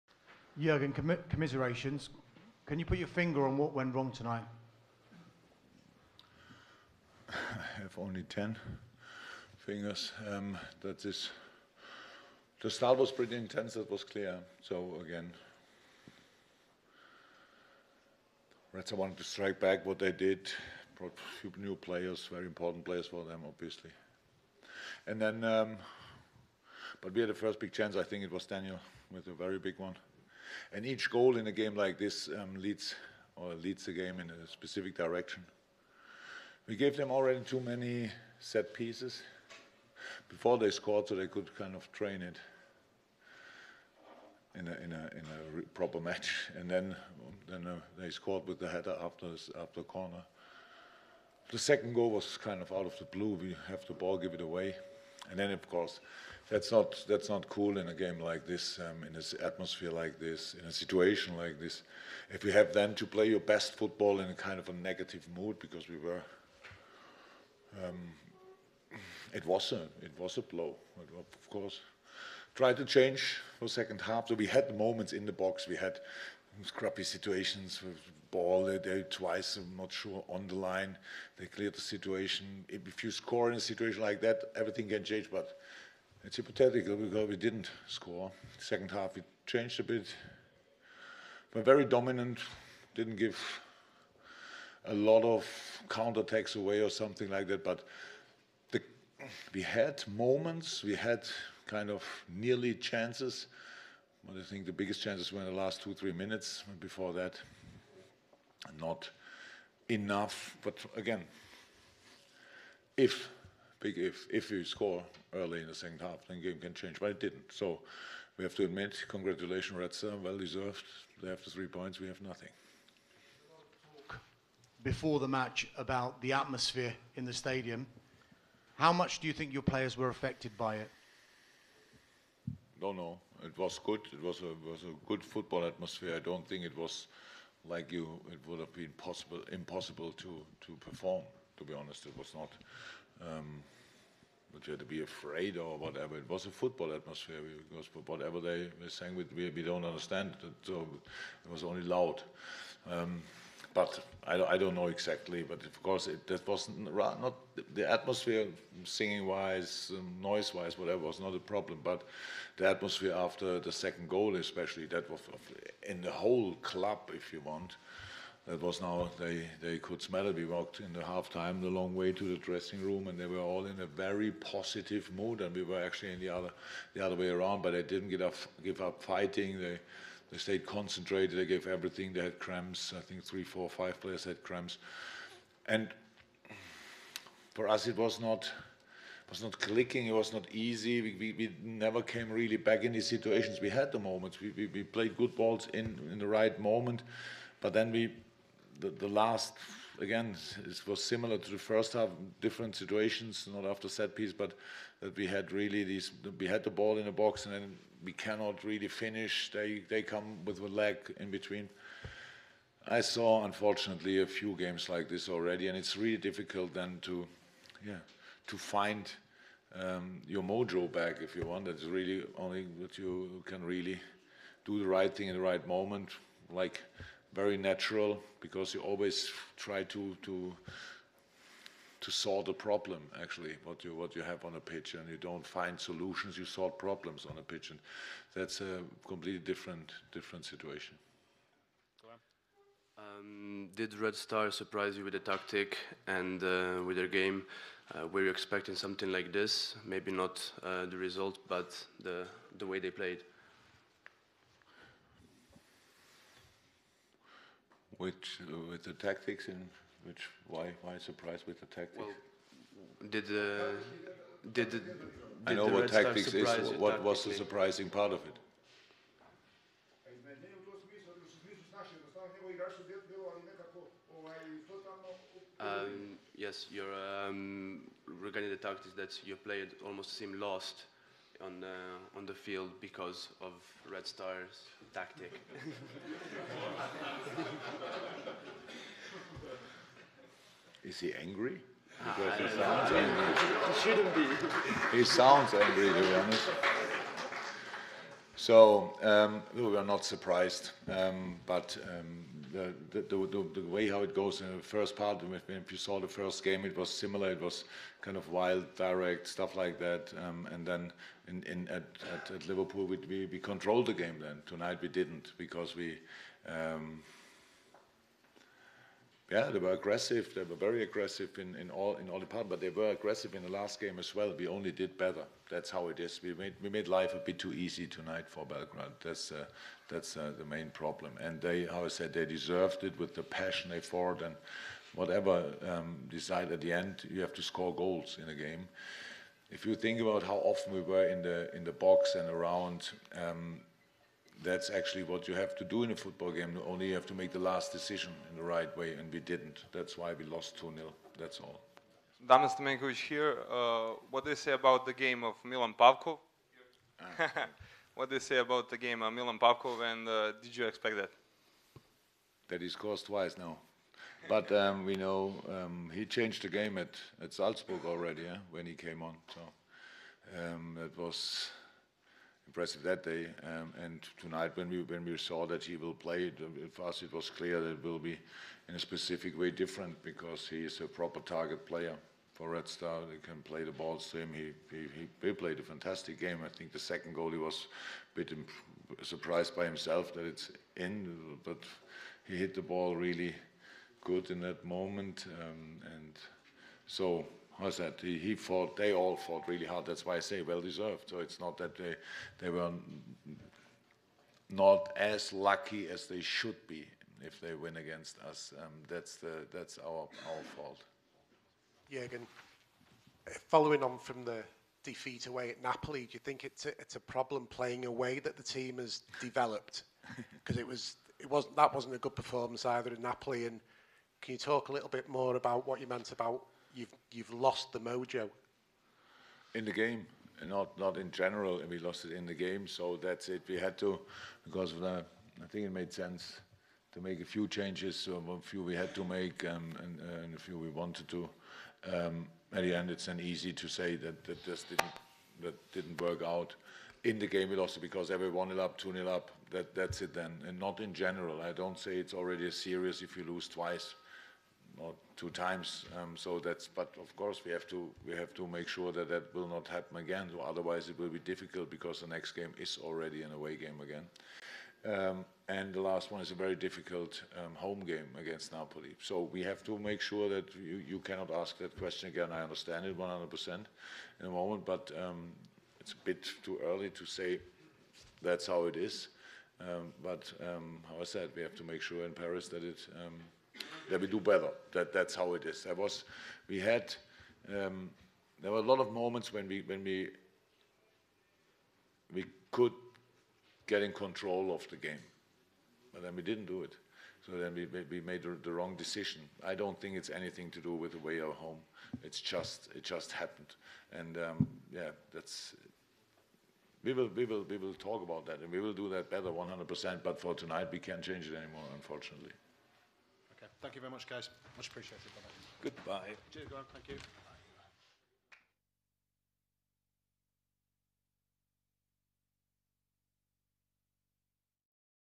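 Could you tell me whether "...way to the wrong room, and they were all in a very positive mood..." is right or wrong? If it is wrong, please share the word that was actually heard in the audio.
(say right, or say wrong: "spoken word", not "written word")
wrong: "dressing", not "wrong".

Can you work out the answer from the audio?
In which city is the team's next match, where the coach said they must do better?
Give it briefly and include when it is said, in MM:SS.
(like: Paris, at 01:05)
Paris, at 08:02.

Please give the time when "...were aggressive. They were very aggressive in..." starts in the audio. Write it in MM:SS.
05:19.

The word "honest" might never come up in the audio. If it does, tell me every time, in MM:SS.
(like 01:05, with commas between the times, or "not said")
02:21, 04:56.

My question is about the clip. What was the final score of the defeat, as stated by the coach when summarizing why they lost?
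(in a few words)
2-0.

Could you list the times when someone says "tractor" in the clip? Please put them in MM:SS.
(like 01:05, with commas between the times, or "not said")
not said.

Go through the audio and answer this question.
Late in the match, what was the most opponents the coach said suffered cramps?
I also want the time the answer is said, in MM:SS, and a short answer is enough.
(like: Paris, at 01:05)
5, at 03:03.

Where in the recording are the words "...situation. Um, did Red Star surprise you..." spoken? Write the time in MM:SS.
04:00.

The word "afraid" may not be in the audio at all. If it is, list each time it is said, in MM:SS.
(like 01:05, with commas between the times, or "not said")
02:25.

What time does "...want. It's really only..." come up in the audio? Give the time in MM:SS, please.
03:41.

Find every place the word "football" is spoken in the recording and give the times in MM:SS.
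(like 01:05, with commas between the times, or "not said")
01:03, 02:15, 02:26, 05:45.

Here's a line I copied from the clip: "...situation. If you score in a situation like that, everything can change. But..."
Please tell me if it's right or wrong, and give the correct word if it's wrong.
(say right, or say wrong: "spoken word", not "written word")
right.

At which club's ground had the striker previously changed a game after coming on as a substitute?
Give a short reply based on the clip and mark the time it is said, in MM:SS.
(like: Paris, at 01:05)
Salzburg, at 06:07.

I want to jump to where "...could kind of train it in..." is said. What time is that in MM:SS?
00:41.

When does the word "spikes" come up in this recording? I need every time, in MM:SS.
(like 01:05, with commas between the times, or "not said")
not said.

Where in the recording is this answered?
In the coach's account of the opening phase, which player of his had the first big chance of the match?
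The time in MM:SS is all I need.
00:28.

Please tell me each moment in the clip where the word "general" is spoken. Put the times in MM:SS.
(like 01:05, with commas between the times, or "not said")
07:11, 07:30.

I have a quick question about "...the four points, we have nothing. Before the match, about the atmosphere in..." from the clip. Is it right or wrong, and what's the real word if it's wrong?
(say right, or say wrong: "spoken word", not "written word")
wrong: "three", not "four".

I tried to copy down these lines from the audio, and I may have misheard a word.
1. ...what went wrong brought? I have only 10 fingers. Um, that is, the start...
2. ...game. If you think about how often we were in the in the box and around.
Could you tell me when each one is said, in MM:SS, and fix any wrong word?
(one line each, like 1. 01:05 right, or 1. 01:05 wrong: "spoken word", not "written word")
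1. 00:03 wrong: "tonight", not "brought"
2. 05:38 right.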